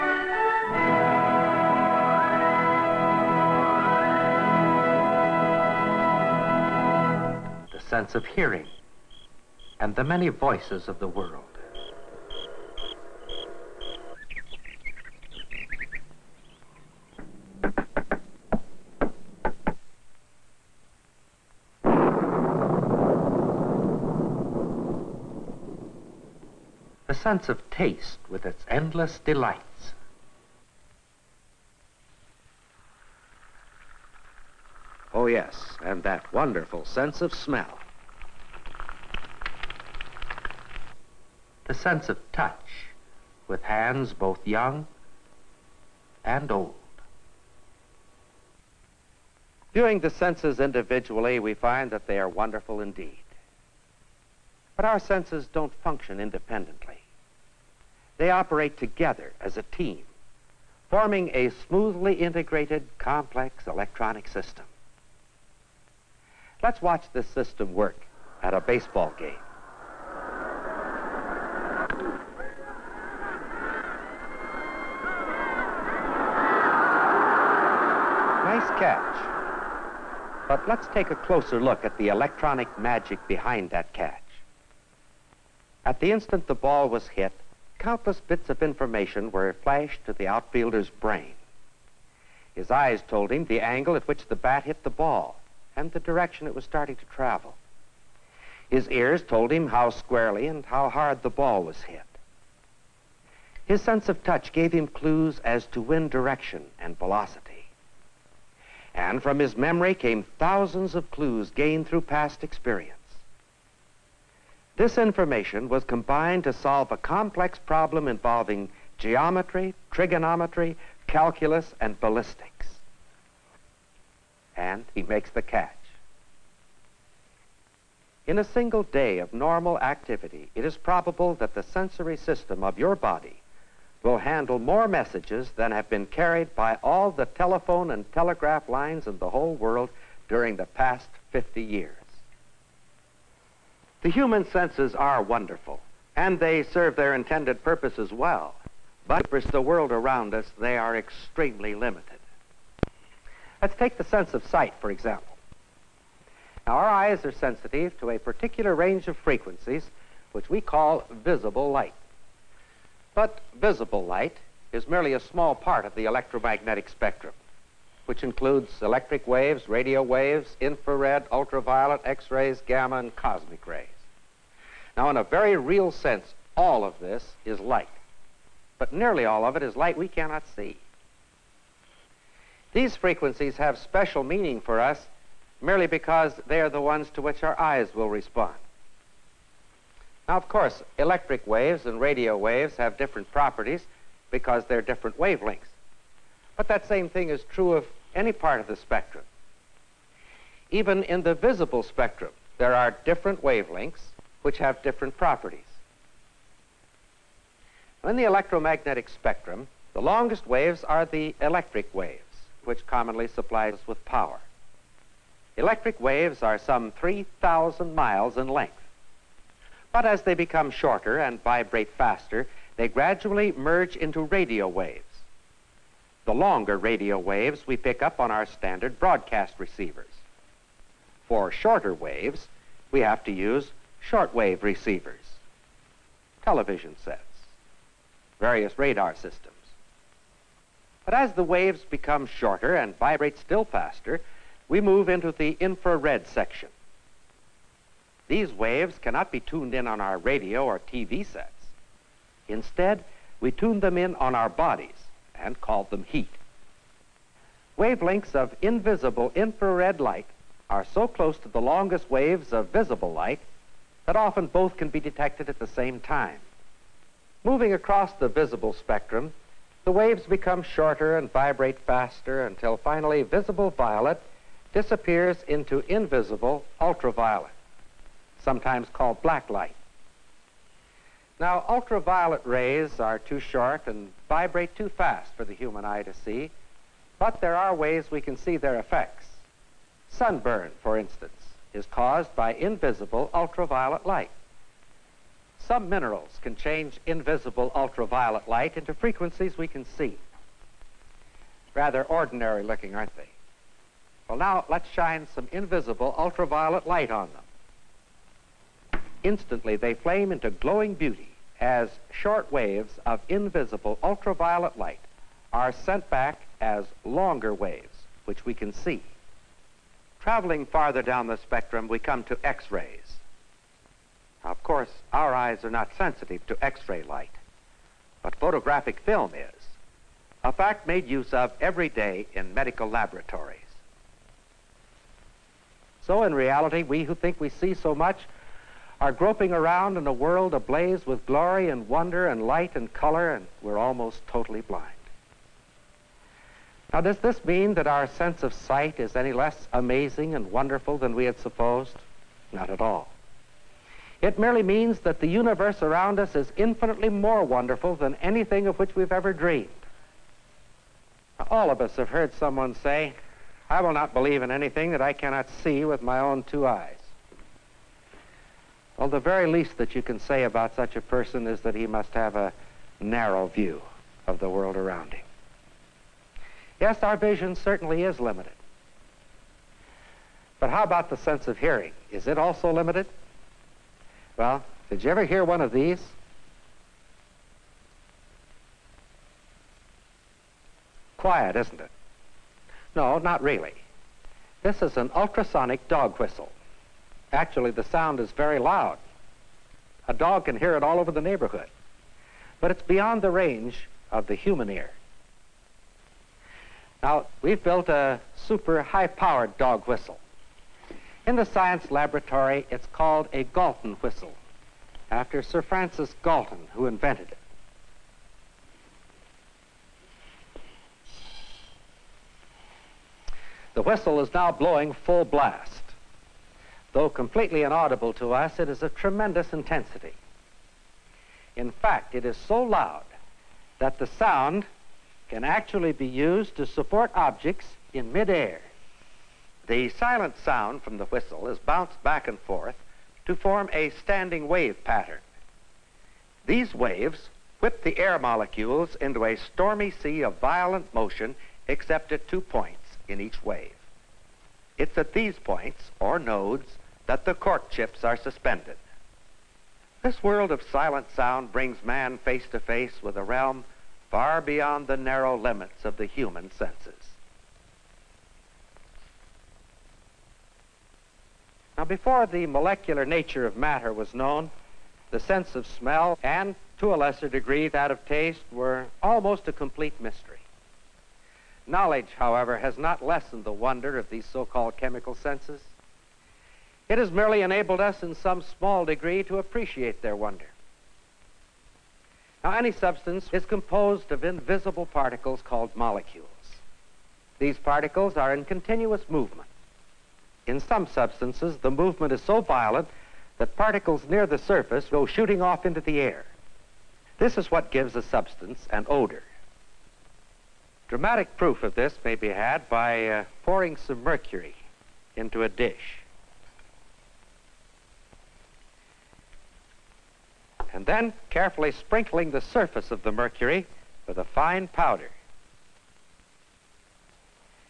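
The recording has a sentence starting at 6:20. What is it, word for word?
But how about the sense of hearing?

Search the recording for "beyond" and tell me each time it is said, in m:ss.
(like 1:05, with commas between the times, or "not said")
6:42, 7:44.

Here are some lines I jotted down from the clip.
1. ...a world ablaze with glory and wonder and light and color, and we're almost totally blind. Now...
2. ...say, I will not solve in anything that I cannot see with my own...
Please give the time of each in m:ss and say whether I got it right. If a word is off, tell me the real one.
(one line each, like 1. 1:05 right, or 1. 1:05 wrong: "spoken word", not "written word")
1. 5:40 right
2. 6:02 wrong: "believe", not "solve".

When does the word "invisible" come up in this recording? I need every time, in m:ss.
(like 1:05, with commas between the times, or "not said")
4:18, 4:35, 4:52, 4:57, 5:05, 5:13, 8:14.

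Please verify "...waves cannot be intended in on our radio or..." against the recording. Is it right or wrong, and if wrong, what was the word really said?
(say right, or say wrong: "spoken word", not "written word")
wrong: "tuned", not "intended".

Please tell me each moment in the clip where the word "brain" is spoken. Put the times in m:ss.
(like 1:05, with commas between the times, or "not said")
1:30.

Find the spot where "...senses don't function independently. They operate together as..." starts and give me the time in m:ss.
0:54.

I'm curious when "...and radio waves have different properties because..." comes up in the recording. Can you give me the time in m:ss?
3:11.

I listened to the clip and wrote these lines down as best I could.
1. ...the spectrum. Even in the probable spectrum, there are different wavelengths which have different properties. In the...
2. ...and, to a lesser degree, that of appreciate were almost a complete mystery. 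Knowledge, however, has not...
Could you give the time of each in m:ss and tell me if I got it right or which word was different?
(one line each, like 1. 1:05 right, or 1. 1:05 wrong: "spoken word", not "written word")
1. 3:18 wrong: "visible", not "probable"
2. 7:56 wrong: "taste", not "appreciate".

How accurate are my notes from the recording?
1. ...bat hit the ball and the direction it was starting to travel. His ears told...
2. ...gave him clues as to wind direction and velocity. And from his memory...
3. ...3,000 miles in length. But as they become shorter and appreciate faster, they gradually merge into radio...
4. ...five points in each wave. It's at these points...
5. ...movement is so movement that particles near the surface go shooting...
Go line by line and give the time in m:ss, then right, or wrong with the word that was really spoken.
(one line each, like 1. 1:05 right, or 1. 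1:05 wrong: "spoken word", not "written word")
1. 1:34 right
2. 1:44 right
3. 3:36 wrong: "vibrate", not "appreciate"
4. 7:32 wrong: "two", not "five"
5. 8:21 wrong: "violent", not "movement".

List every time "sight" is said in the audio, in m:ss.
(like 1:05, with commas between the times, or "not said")
2:34, 5:48.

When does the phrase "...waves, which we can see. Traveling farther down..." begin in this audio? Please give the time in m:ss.
5:17.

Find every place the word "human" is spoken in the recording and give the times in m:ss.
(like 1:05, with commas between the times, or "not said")
2:24, 4:45, 6:44, 7:46.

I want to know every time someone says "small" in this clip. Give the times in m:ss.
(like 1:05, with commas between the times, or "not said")
2:45, 8:08.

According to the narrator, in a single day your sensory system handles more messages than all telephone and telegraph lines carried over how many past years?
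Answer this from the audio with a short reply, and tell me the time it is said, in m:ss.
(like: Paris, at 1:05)
50, at 2:21.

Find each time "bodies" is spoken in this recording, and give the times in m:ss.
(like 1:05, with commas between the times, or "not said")
4:14.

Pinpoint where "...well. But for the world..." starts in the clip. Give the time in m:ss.
2:28.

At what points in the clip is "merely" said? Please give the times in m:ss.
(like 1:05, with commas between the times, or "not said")
2:44, 3:05, 5:54, 8:07.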